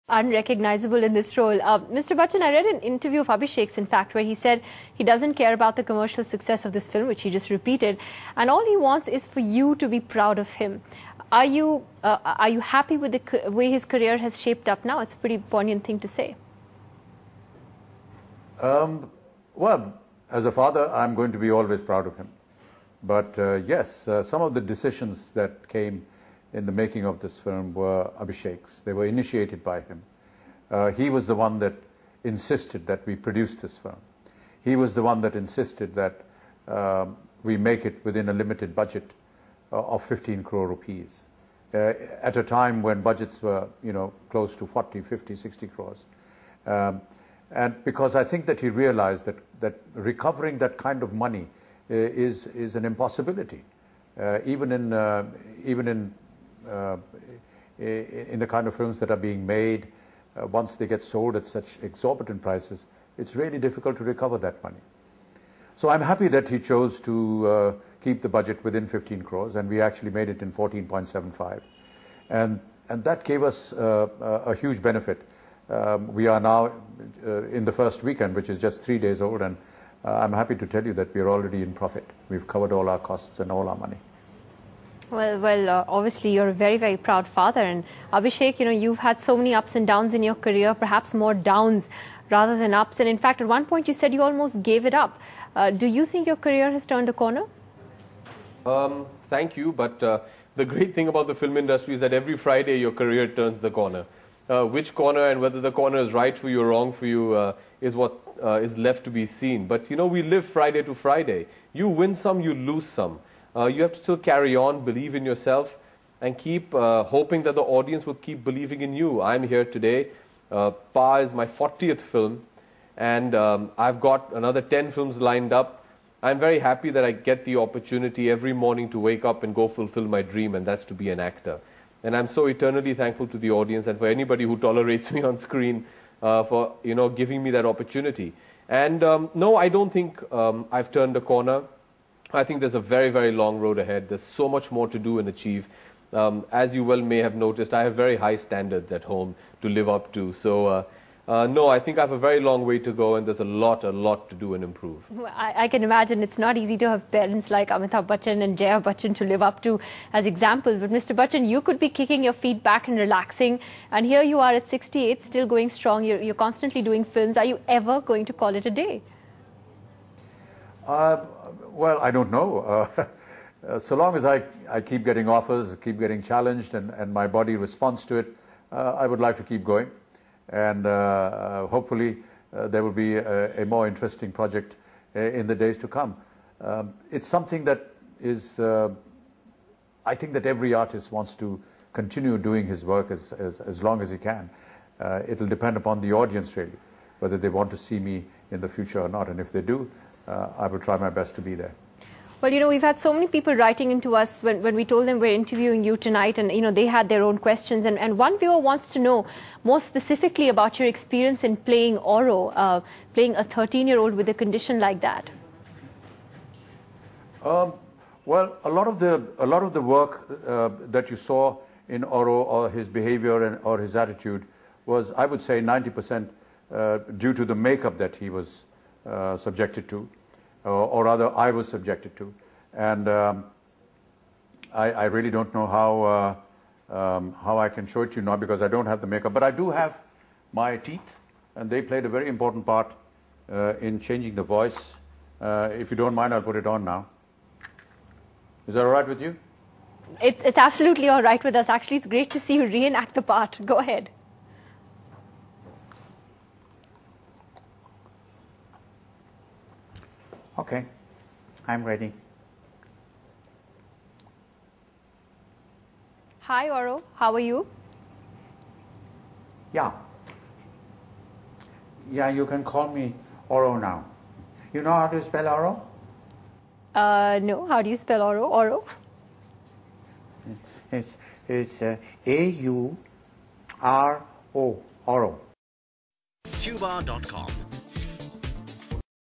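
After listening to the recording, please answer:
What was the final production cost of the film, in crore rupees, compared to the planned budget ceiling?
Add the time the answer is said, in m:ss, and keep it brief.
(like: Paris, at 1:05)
14.75, at 1:10.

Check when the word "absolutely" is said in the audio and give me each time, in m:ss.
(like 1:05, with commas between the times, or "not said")
4:10.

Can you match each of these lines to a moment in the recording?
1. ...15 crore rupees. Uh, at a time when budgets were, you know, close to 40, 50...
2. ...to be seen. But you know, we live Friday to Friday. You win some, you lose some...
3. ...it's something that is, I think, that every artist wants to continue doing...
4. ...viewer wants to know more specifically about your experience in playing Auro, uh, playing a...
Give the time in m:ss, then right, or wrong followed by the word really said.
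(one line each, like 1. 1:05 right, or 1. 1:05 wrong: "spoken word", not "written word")
1. 0:40 right
2. 1:49 right
3. 3:07 right
4. 3:28 right.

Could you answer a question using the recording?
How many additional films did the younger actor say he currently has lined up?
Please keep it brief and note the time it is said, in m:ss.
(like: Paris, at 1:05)
10, at 2:04.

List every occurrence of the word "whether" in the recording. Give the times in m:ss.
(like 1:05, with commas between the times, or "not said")
1:45, 3:17.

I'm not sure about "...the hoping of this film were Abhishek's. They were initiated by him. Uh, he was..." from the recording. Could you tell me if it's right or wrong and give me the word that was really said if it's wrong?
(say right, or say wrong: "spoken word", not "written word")
wrong: "making", not "hoping".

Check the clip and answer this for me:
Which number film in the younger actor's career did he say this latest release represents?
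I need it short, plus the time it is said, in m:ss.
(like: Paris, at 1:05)
40th, at 2:01.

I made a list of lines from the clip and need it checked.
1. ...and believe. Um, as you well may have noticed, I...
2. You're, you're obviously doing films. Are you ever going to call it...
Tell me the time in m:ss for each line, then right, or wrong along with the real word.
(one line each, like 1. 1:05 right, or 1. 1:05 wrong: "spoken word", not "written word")
1. 2:25 wrong: "achieve", not "believe"
2. 2:46 wrong: "constantly", not "obviously".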